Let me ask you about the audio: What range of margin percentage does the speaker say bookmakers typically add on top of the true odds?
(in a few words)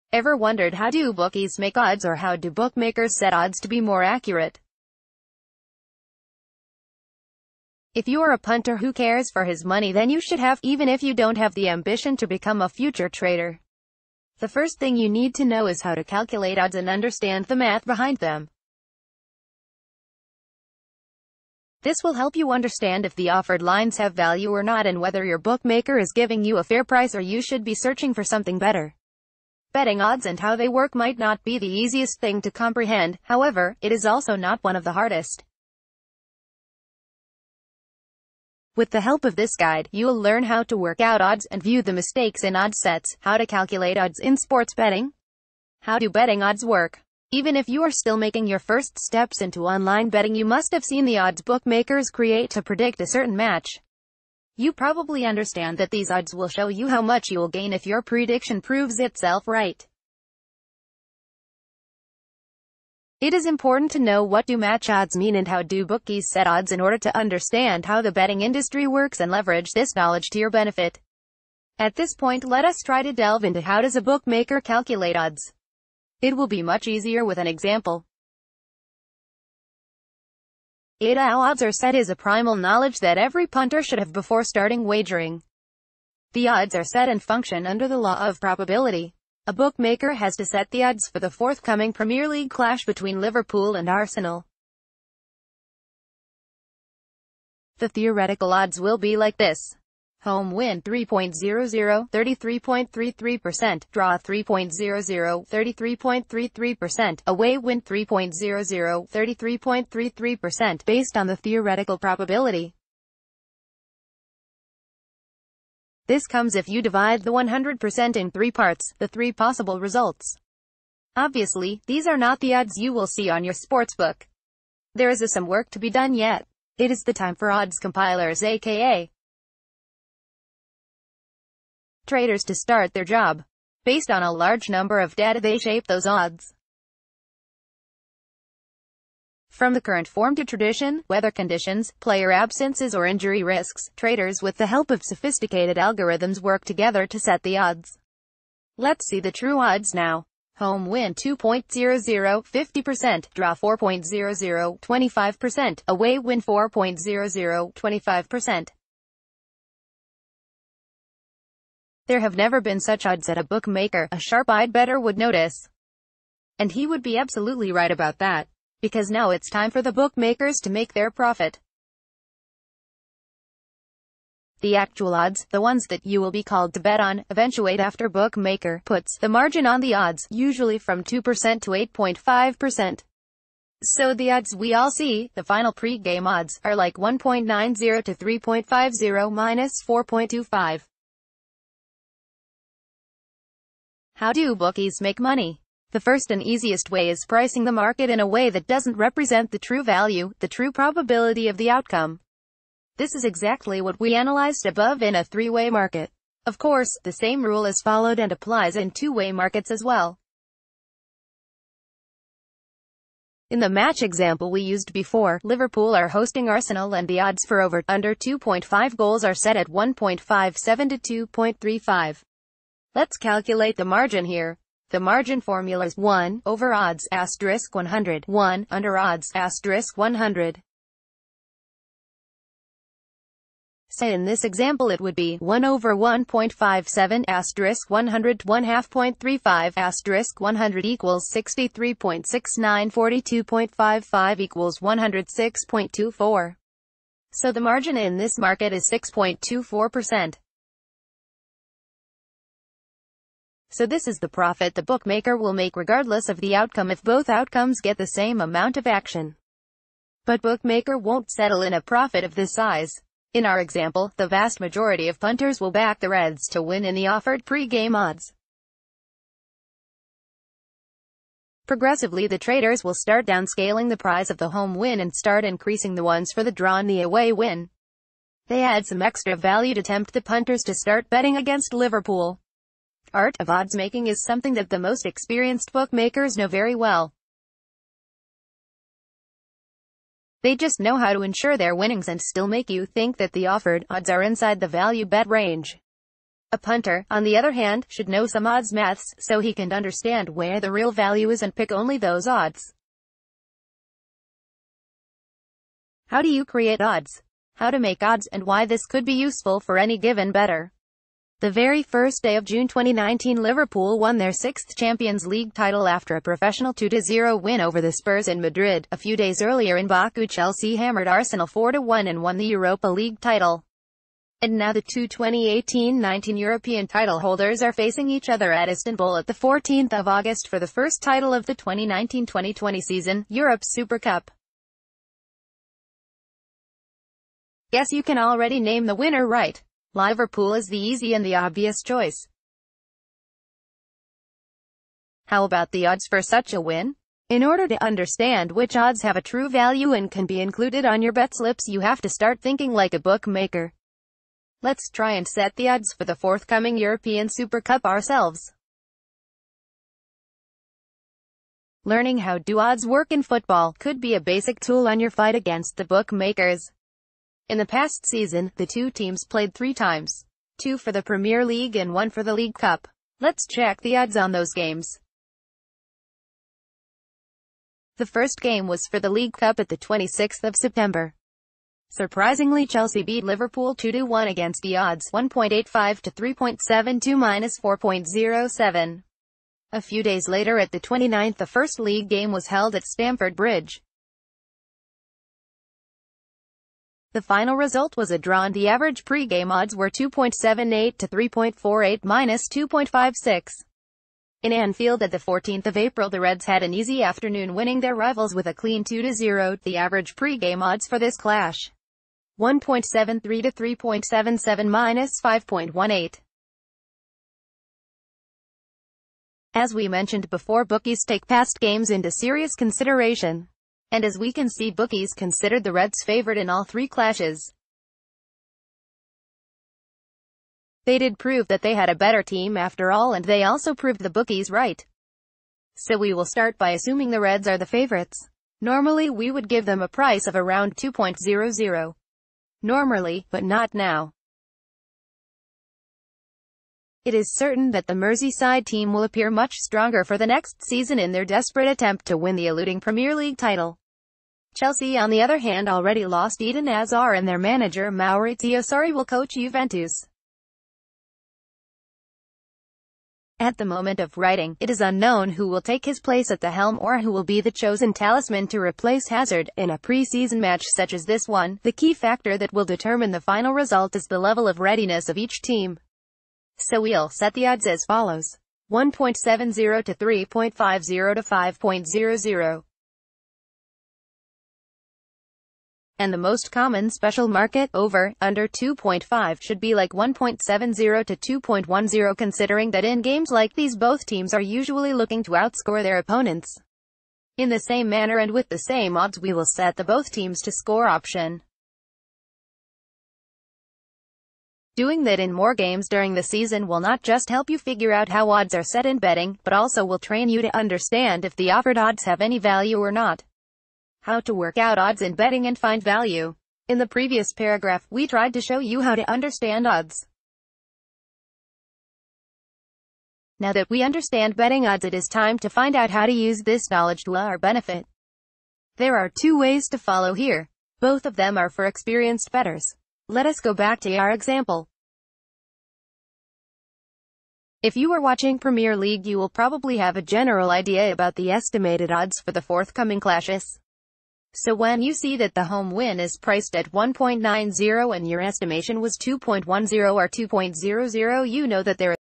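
2% to 8.5%.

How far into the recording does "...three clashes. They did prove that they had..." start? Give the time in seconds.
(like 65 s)
426 s.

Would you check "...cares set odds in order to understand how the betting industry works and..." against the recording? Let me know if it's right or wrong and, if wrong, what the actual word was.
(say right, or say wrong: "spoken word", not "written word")
wrong: "bookies", not "cares".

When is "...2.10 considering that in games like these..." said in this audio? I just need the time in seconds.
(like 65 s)
491 s.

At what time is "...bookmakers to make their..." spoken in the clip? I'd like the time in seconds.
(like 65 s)
169 s.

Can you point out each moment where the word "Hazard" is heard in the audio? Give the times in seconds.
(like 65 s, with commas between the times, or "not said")
456 s, 469 s.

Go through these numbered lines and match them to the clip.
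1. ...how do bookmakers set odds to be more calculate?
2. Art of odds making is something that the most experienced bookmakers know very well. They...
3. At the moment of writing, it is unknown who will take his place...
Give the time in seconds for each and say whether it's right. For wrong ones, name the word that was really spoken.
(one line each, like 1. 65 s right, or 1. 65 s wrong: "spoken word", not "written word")
1. 2 s wrong: "accurate", not "calculate"
2. 283 s right
3. 463 s right.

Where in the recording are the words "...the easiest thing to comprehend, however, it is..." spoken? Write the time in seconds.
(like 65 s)
31 s.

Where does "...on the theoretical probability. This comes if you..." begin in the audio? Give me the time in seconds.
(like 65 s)
111 s.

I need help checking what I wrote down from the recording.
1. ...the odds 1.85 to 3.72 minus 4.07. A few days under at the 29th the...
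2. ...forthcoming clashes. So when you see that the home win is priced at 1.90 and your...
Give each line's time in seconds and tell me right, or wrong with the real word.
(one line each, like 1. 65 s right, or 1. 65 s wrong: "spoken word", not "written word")
1. 384 s wrong: "later", not "under"
2. 542 s right.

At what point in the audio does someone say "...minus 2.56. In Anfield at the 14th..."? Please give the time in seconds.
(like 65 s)
402 s.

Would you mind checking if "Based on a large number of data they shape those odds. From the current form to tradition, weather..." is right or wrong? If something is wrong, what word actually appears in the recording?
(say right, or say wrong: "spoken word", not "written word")
right.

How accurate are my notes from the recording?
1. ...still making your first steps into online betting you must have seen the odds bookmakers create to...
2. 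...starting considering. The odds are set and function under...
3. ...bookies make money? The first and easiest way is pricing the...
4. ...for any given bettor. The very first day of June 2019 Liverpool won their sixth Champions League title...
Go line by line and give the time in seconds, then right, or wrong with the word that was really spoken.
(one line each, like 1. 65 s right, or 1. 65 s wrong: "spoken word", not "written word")
1. 47 s right
2. 84 s wrong: "wagering", not "considering"
3. 194 s right
4. 309 s right.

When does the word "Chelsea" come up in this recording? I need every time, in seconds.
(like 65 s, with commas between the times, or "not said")
320 s, 382 s, 454 s.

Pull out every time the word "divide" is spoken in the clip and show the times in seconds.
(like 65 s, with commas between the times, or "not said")
116 s.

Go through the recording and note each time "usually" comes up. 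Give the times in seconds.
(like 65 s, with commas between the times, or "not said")
180 s, 494 s.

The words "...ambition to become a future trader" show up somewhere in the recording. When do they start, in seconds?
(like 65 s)
11 s.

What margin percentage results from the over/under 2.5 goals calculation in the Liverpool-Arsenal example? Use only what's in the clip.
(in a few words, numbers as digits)
6.24%.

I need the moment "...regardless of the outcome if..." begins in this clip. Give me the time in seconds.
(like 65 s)
255 s.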